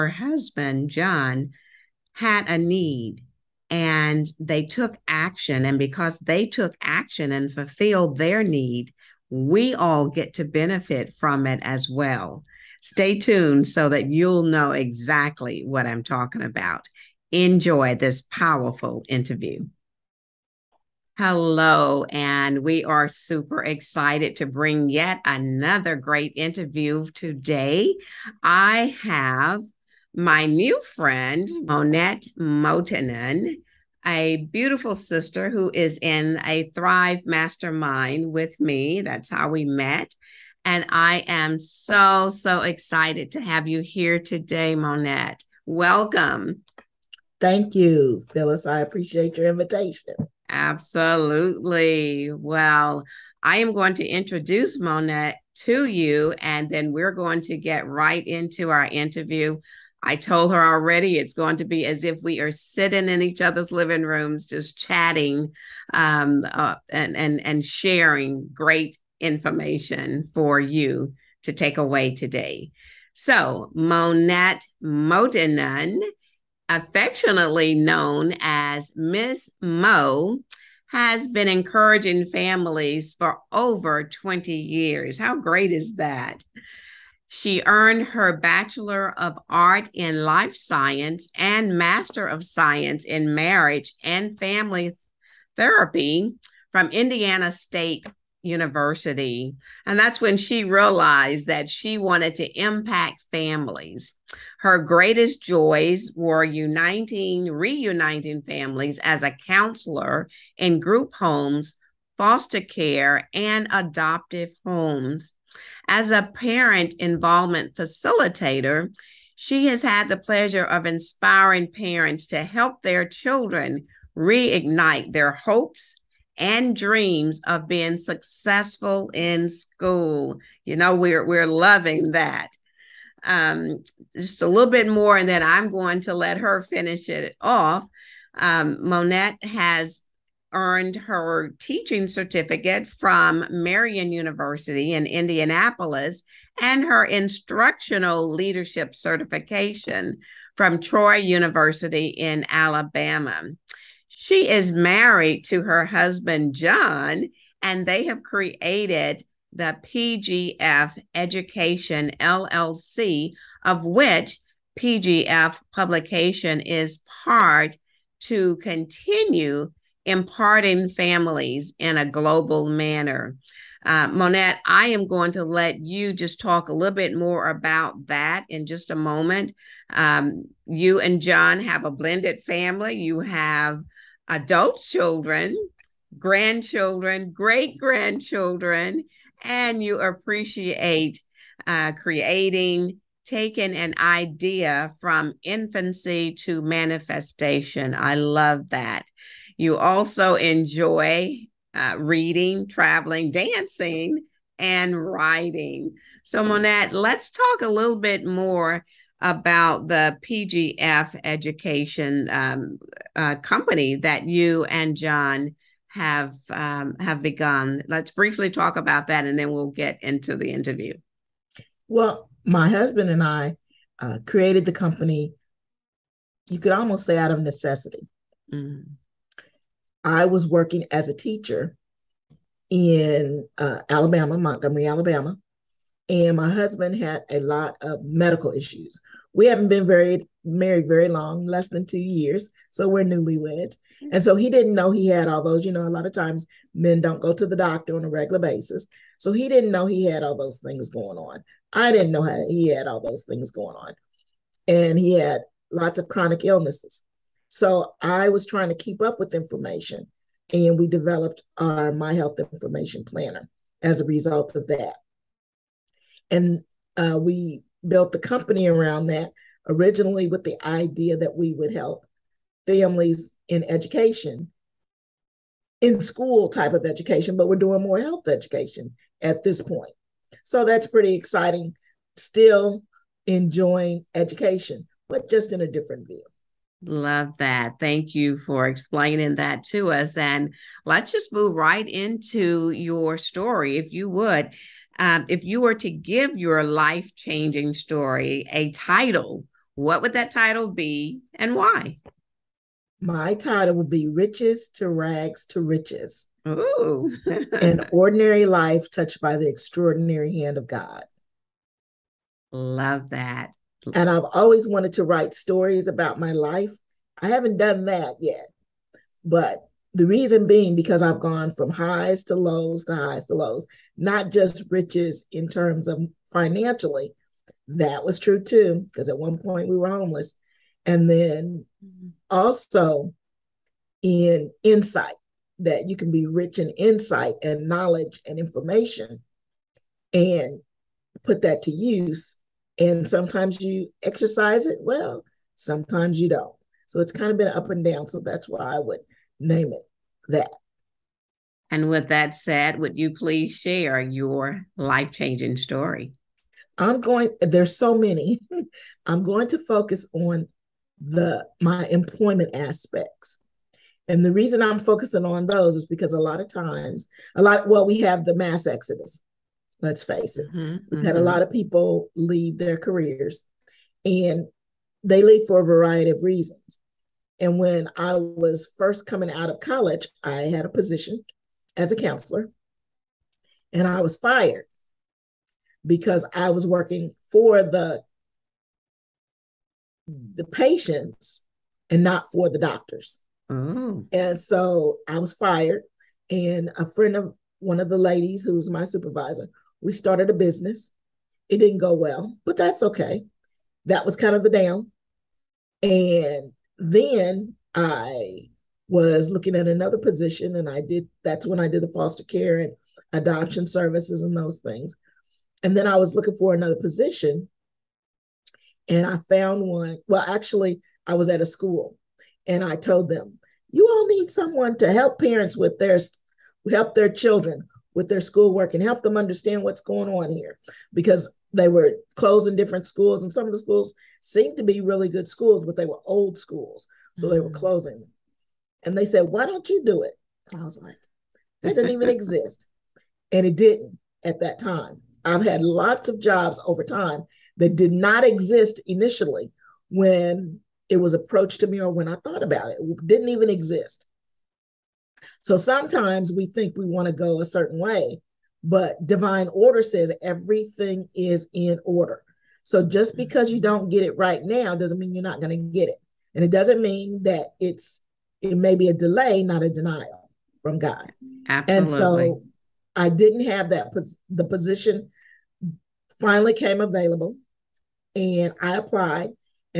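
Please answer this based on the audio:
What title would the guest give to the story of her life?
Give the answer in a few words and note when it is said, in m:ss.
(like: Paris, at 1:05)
Riches to Rags to Riches, at 5:04.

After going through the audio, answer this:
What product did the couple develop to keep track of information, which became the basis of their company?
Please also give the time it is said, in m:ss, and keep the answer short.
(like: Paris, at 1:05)
My Health Information Planner, at 4:21.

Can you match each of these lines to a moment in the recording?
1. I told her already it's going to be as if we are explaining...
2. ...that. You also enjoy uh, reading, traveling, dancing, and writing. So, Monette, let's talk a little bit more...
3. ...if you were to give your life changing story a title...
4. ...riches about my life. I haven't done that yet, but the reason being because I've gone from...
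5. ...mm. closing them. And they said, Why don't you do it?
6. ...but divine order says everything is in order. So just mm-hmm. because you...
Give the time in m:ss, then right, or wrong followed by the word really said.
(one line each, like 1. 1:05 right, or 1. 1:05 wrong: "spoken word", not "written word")
1. 1:00 wrong: "sitting", not "explaining"
2. 3:18 right
3. 4:55 right
4. 5:15 wrong: "stories", not "riches"
5. 7:17 right
6. 7:38 right.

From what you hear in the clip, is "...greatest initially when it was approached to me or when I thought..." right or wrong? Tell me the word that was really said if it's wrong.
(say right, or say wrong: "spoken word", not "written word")
wrong: "exist", not "greatest".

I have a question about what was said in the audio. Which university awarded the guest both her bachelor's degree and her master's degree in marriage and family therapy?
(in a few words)
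Indiana State University.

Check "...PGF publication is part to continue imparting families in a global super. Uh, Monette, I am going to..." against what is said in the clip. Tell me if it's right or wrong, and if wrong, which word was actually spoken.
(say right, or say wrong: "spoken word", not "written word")
wrong: "manner", not "super".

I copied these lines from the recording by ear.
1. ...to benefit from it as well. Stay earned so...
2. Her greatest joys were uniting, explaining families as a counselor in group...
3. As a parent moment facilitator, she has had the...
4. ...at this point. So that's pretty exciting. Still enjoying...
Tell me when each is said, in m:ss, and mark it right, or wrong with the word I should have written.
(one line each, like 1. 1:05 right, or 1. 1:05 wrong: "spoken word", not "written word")
1. 0:10 wrong: "tuned", not "earned"
2. 1:44 wrong: "reuniting", not "explaining"
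3. 1:55 wrong: "involvement", not "moment"
4. 4:39 right.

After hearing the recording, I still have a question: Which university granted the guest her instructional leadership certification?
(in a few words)
Troy University.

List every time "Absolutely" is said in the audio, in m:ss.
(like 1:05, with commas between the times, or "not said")
0:50, 7:51.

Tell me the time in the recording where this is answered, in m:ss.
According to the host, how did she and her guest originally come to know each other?
0:36.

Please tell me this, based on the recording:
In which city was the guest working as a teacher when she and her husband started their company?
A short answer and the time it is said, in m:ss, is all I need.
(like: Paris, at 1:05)
Montgomery, at 3:54.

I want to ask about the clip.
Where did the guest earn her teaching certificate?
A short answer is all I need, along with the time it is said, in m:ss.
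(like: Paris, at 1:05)
Marian University, at 2:23.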